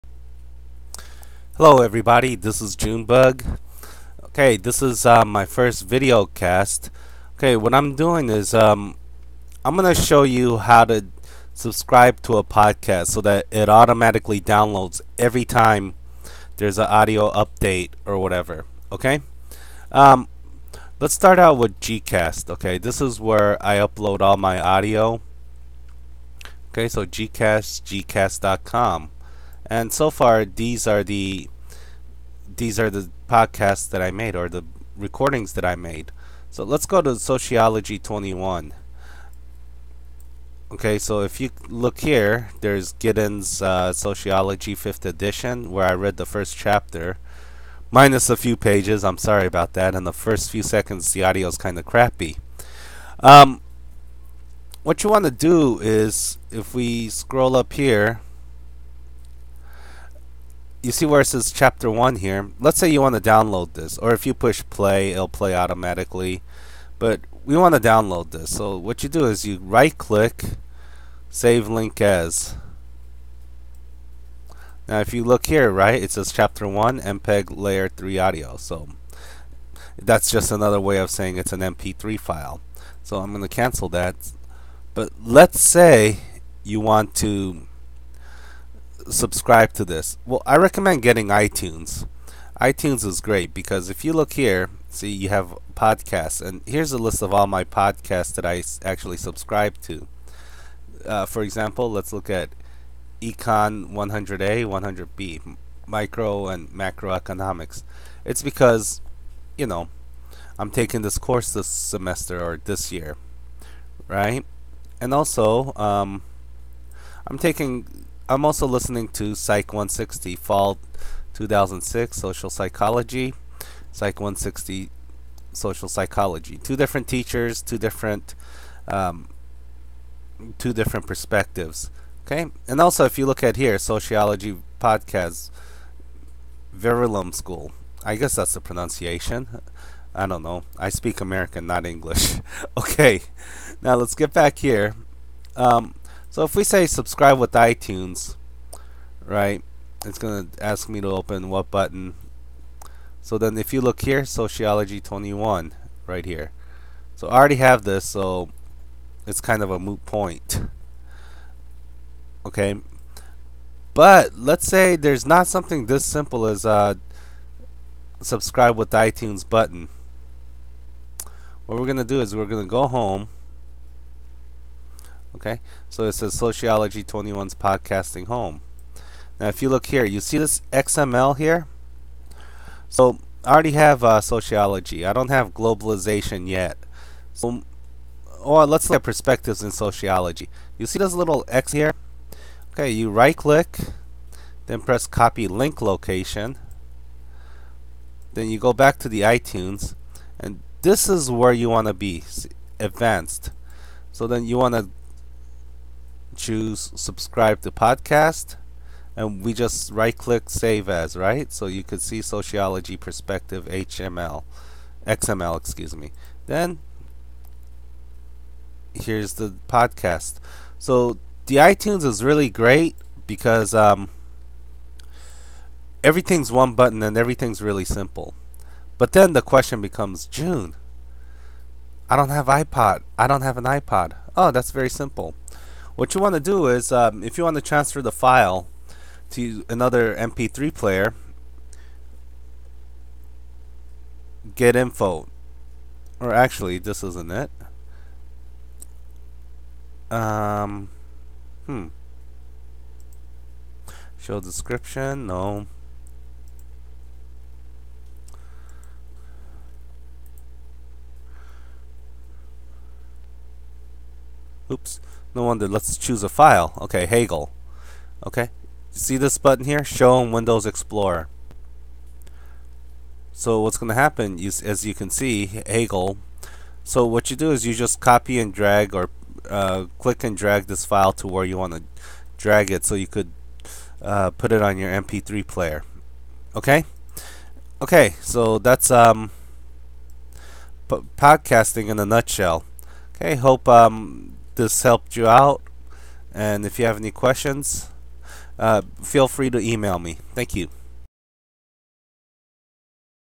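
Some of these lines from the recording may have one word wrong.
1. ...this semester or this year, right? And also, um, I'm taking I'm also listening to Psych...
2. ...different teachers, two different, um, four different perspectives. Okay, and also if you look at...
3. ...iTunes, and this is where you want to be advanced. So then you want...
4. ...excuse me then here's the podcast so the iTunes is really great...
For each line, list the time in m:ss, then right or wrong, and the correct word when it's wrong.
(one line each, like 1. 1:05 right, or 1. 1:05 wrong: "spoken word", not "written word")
1. 1:51 right
2. 2:06 wrong: "two", not "four"
3. 3:19 right
4. 3:35 right.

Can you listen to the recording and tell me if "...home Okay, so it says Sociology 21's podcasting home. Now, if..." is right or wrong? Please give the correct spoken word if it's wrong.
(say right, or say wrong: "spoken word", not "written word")
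right.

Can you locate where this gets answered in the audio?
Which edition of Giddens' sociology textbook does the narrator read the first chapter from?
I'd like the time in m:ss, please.
0:44.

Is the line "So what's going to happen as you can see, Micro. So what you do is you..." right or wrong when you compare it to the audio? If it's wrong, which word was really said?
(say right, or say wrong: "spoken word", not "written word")
wrong: "Hagel", not "Micro".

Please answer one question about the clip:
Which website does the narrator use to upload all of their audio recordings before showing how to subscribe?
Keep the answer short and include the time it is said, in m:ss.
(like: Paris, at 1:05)
Gcast.com, at 0:27.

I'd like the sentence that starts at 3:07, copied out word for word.
So, or oh, let's look at perspectives in sociology.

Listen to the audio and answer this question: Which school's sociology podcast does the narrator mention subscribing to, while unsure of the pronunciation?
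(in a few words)
Verulam School.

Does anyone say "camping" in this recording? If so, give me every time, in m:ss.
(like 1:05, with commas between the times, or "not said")
not said.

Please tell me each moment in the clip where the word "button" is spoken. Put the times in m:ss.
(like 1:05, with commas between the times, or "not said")
2:31, 2:49, 3:46, 4:29.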